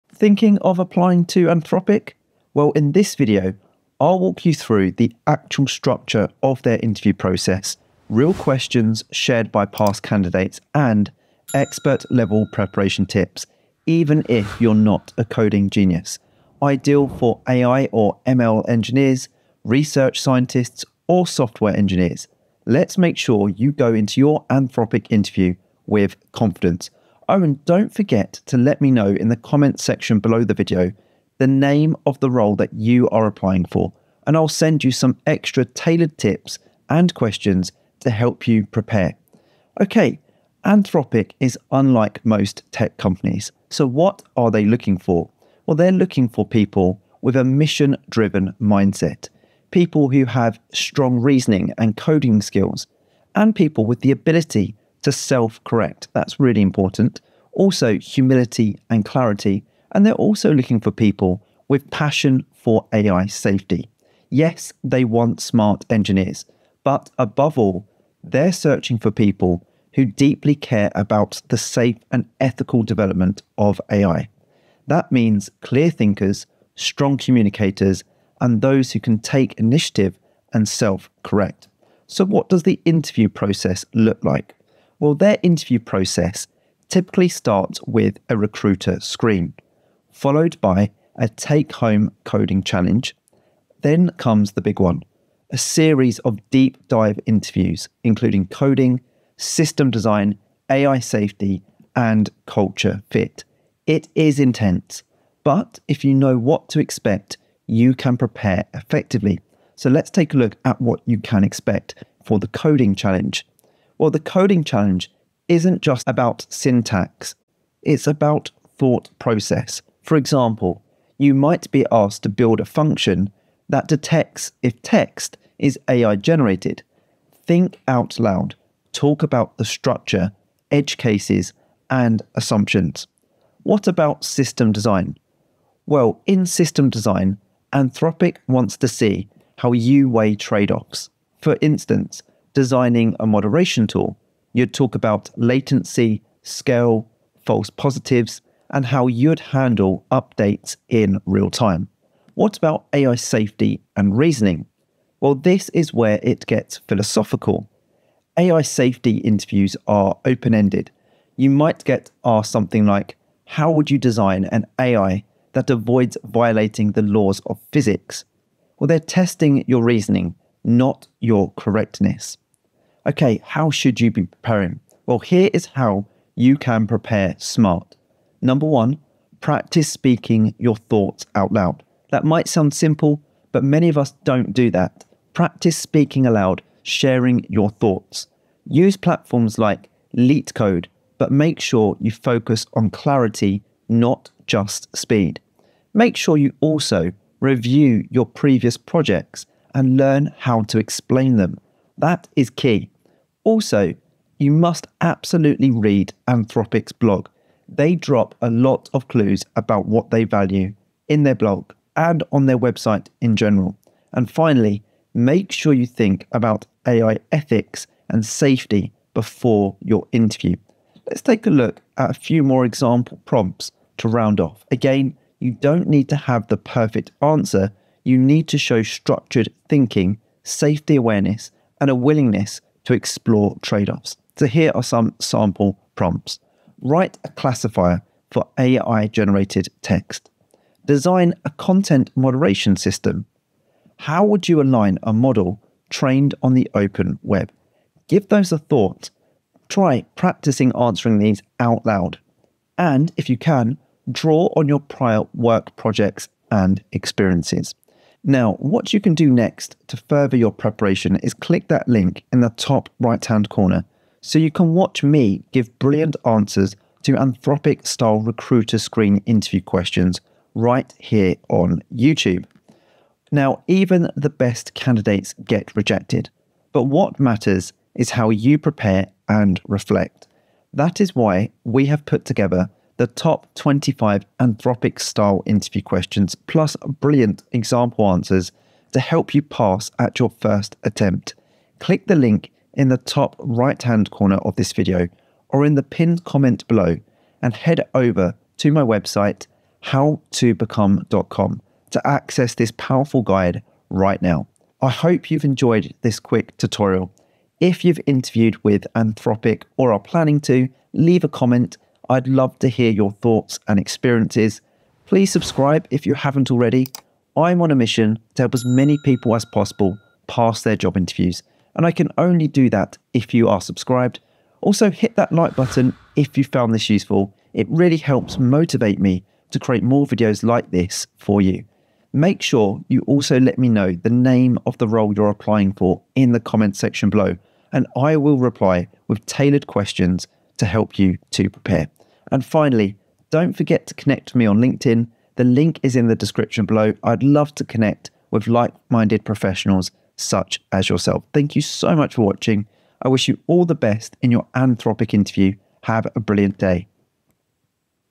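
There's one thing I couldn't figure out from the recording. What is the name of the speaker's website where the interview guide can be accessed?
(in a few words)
how2become.com.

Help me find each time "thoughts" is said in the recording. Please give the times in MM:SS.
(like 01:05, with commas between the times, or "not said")
01:58, 03:00, 03:07, 04:08, 05:13.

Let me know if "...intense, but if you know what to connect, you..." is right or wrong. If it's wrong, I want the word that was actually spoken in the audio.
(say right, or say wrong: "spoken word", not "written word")
wrong: "expect", not "connect".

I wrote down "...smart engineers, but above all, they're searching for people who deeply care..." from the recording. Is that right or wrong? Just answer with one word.
right.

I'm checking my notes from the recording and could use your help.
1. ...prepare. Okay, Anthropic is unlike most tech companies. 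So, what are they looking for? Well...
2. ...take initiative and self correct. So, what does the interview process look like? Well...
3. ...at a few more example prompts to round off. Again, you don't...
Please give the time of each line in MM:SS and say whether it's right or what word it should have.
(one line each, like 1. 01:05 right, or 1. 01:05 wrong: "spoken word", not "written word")
1. 00:38 right
2. 01:19 right
3. 03:41 right.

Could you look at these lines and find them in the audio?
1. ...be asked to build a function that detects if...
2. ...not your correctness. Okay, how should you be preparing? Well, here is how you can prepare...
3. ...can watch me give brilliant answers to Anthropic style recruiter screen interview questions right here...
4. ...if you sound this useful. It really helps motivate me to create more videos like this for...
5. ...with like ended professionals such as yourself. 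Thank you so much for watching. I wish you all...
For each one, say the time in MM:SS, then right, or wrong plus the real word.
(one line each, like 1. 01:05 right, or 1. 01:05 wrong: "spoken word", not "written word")
1. 02:01 right
2. 02:50 right
3. 04:24 right
4. 05:26 wrong: "found", not "sound"
5. 05:48 wrong: "minded", not "ended".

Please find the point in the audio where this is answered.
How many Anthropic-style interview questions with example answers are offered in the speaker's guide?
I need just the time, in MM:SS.
04:43.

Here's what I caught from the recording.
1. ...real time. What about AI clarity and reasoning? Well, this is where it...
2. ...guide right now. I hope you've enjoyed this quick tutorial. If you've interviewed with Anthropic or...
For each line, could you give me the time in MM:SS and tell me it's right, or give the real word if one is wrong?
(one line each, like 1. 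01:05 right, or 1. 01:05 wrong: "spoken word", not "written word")
1. 02:31 wrong: "safety", not "clarity"
2. 05:03 right.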